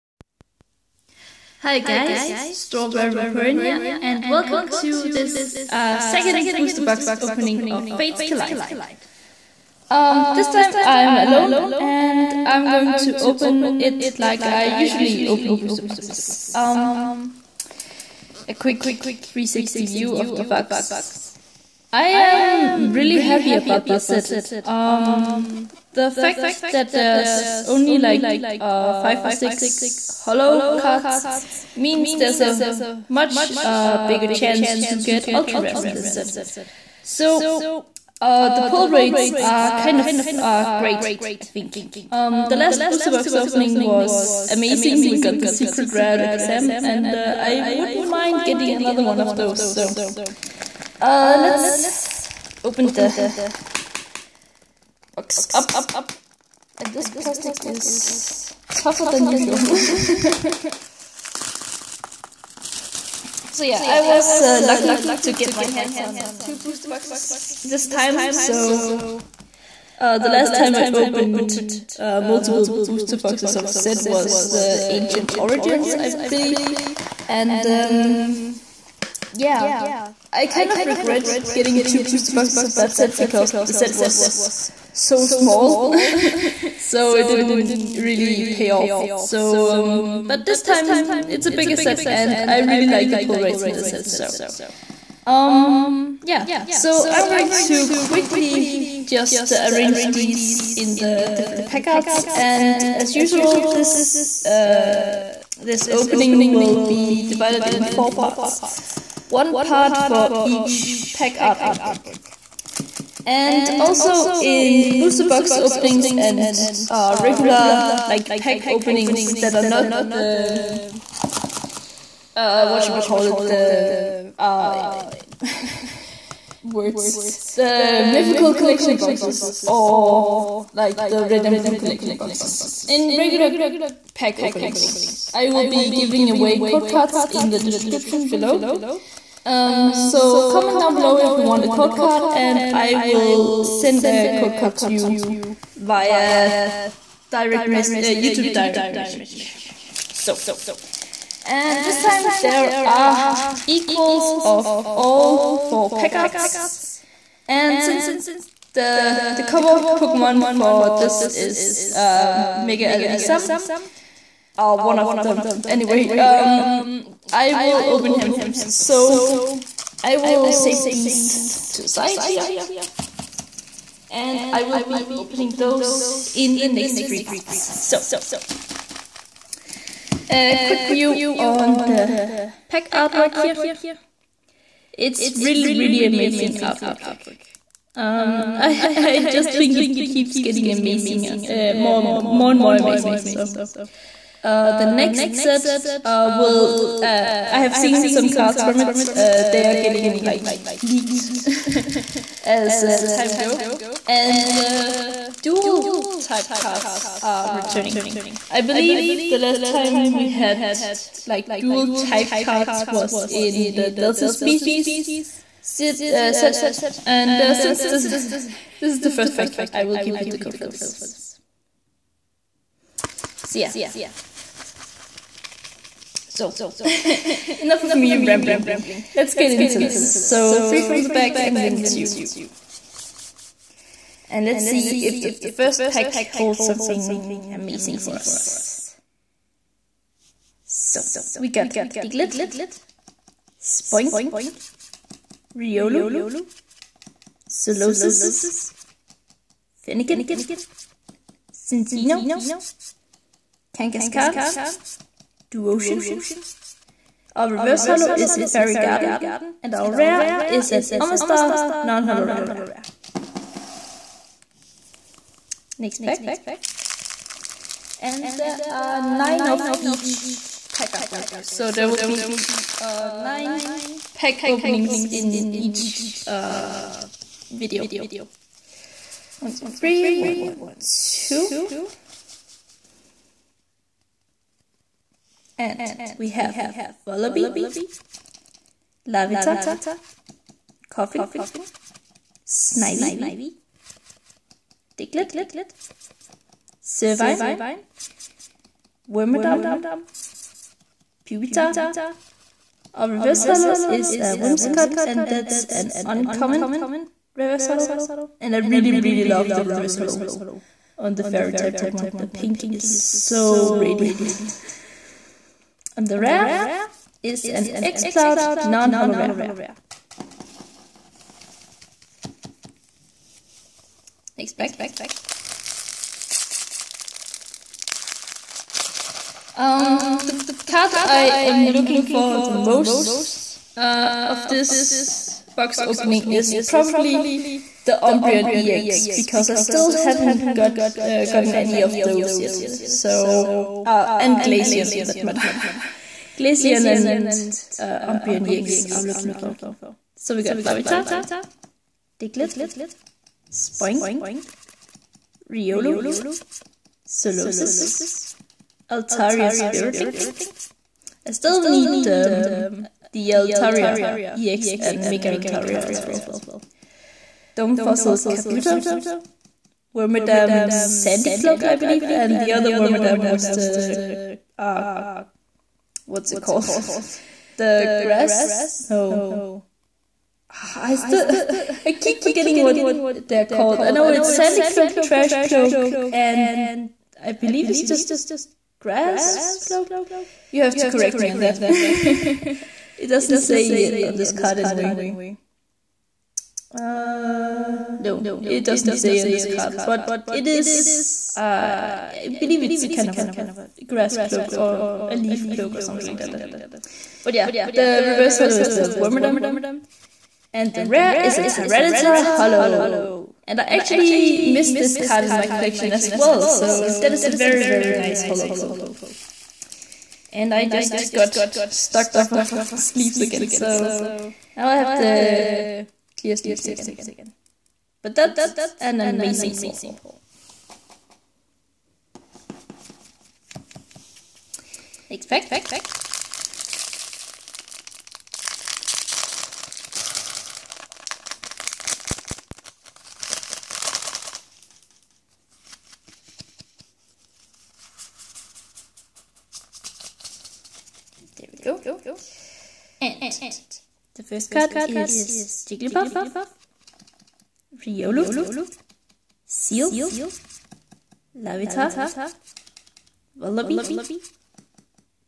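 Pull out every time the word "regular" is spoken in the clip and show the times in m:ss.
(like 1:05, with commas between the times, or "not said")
1:57, 2:13.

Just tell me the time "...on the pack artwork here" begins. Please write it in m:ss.
3:01.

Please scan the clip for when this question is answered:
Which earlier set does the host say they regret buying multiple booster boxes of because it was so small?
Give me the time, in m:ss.
1:14.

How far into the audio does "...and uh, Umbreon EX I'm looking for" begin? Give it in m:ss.
5:46.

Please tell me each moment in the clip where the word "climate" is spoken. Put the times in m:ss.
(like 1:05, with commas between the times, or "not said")
not said.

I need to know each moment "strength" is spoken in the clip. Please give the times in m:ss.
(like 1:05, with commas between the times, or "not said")
not said.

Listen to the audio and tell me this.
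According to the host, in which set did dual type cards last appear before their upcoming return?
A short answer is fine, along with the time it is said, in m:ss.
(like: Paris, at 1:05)
Delta Species, at 3:33.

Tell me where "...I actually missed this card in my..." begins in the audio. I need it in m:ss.
6:53.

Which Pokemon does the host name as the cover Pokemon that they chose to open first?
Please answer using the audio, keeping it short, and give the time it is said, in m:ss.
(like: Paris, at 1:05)
Mega Alakazam, at 2:42.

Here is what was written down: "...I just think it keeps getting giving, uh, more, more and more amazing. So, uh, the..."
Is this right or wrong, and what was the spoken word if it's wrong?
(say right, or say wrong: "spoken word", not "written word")
wrong: "amazing", not "giving".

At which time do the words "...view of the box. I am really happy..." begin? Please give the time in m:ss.
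0:19.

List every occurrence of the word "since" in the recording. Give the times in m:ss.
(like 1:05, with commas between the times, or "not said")
2:37, 3:37.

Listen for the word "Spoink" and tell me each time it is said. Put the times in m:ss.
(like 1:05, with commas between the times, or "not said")
4:03, 5:53.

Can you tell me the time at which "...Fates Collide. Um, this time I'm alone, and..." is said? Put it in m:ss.
0:07.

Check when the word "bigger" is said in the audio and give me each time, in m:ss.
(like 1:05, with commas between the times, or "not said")
0:34, 1:31.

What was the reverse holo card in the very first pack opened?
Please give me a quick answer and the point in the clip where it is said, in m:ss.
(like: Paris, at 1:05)
Fairy Garden, at 4:18.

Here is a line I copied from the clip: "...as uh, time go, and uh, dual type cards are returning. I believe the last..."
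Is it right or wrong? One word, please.
right.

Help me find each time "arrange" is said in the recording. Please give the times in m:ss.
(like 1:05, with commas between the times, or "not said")
1:39.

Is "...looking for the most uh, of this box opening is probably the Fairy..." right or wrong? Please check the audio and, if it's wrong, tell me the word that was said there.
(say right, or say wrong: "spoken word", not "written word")
wrong: "Umbreon", not "Fairy".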